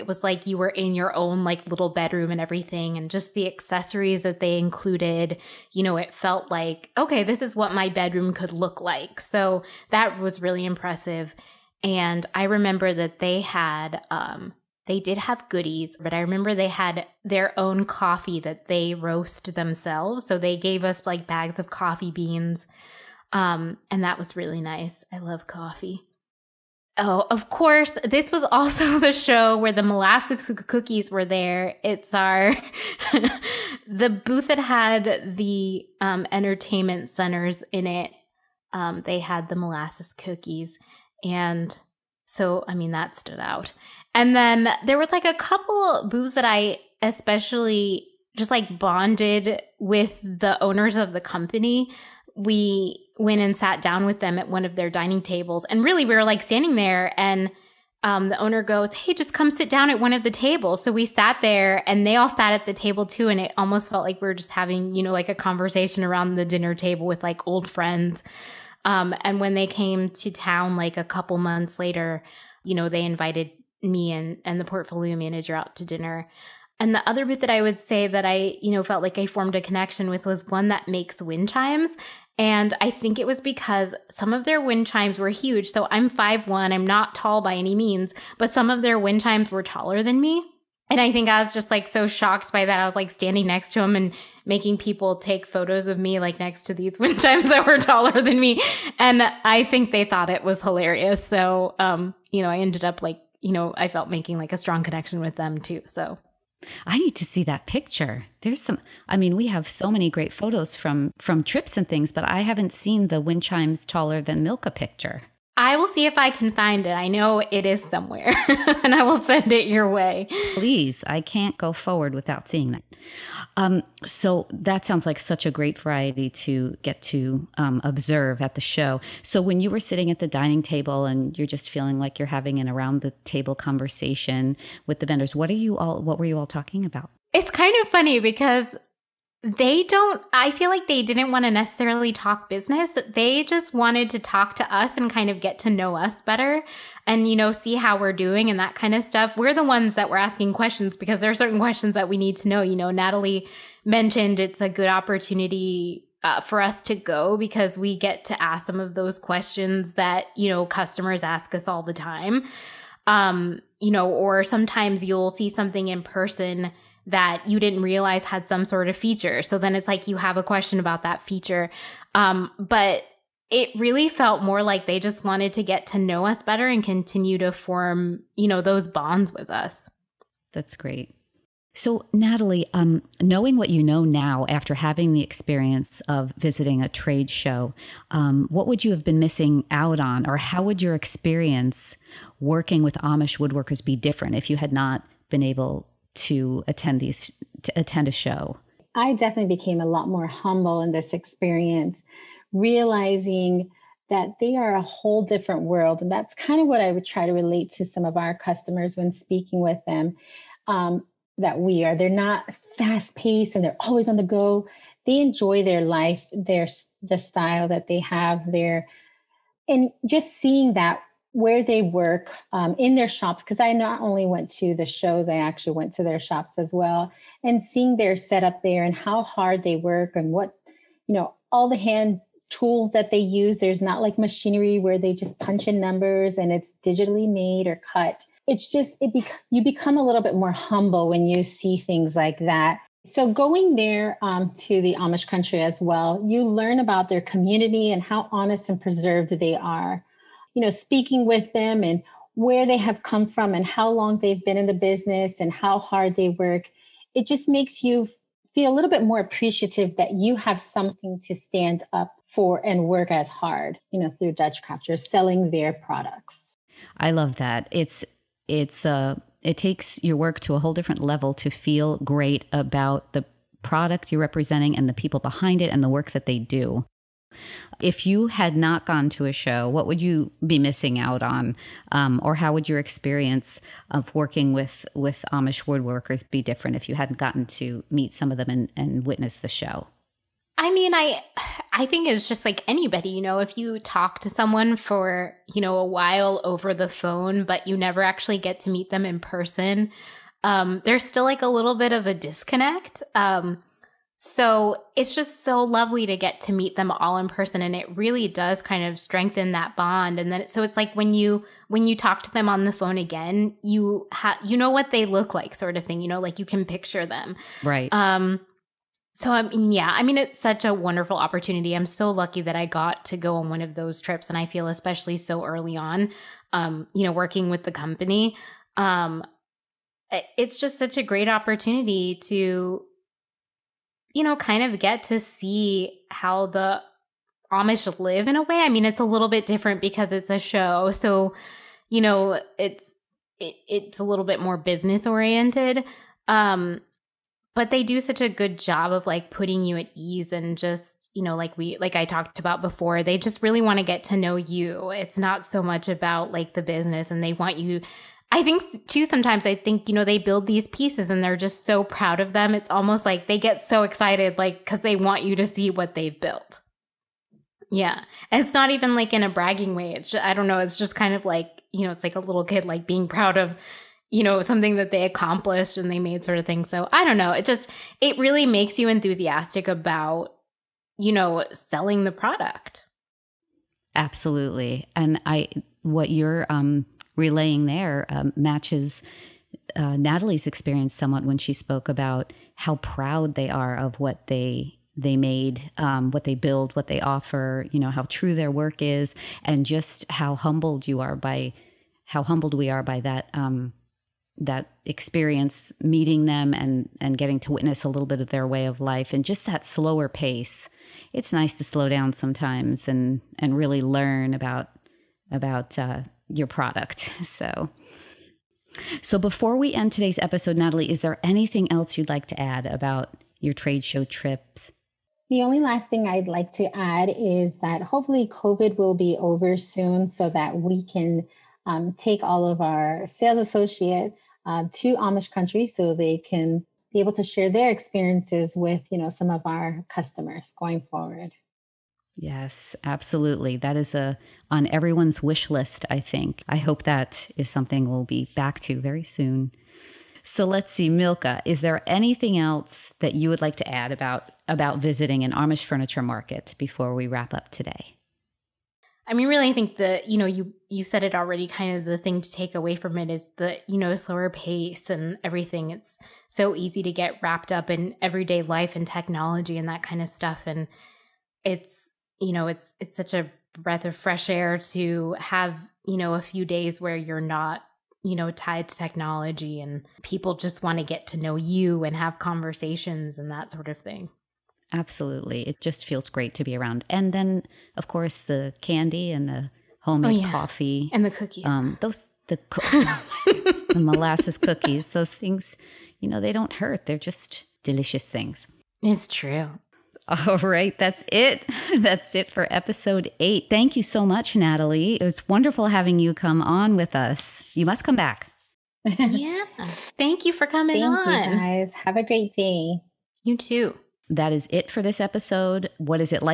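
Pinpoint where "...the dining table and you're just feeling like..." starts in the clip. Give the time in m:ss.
2:10.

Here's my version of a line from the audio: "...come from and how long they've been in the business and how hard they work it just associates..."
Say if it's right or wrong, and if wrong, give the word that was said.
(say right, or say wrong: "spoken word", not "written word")
wrong: "makes", not "associates".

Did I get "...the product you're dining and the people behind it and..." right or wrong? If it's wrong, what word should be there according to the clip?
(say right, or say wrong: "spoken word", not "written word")
wrong: "representing", not "dining".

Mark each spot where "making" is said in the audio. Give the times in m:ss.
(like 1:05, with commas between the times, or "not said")
1:34, 1:44.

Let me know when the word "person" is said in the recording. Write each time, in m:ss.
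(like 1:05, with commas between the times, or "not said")
2:46, 4:59, 5:07.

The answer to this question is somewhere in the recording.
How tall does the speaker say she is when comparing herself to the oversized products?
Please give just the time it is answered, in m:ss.
1:26.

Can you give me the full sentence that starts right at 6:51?
It's nice to slow down sometimes and and really learn about about uh, your product.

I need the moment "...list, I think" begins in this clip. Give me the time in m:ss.
7:25.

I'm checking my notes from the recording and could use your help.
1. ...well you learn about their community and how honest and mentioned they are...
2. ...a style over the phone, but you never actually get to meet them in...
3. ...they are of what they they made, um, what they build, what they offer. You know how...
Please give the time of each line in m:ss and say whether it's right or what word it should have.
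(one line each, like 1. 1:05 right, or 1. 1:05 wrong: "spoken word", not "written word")
1. 4:05 wrong: "preserved", not "mentioned"
2. 4:55 wrong: "while", not "style"
3. 6:33 right.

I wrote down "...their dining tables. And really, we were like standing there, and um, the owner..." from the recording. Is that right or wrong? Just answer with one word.
right.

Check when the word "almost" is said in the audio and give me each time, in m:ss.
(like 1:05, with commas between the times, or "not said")
1:03, 6:02.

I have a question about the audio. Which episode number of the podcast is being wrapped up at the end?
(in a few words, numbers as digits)
8.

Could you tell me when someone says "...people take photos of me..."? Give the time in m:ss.
1:34.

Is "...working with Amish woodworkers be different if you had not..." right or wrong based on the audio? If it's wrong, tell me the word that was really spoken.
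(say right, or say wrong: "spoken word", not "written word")
right.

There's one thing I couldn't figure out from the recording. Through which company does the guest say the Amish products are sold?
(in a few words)
Dutch Craft.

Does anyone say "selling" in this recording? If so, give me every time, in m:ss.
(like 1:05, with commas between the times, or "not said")
4:24, 6:21.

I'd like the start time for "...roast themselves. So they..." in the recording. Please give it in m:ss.
0:18.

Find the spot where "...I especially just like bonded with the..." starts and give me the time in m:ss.
0:46.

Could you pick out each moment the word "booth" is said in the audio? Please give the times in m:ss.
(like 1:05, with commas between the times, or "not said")
0:34, 0:46, 1:17.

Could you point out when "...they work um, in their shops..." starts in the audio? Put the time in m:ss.
3:41.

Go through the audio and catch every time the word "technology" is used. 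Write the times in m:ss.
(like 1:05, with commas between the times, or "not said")
7:48, 7:58.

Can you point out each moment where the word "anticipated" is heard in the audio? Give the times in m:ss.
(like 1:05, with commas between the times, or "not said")
not said.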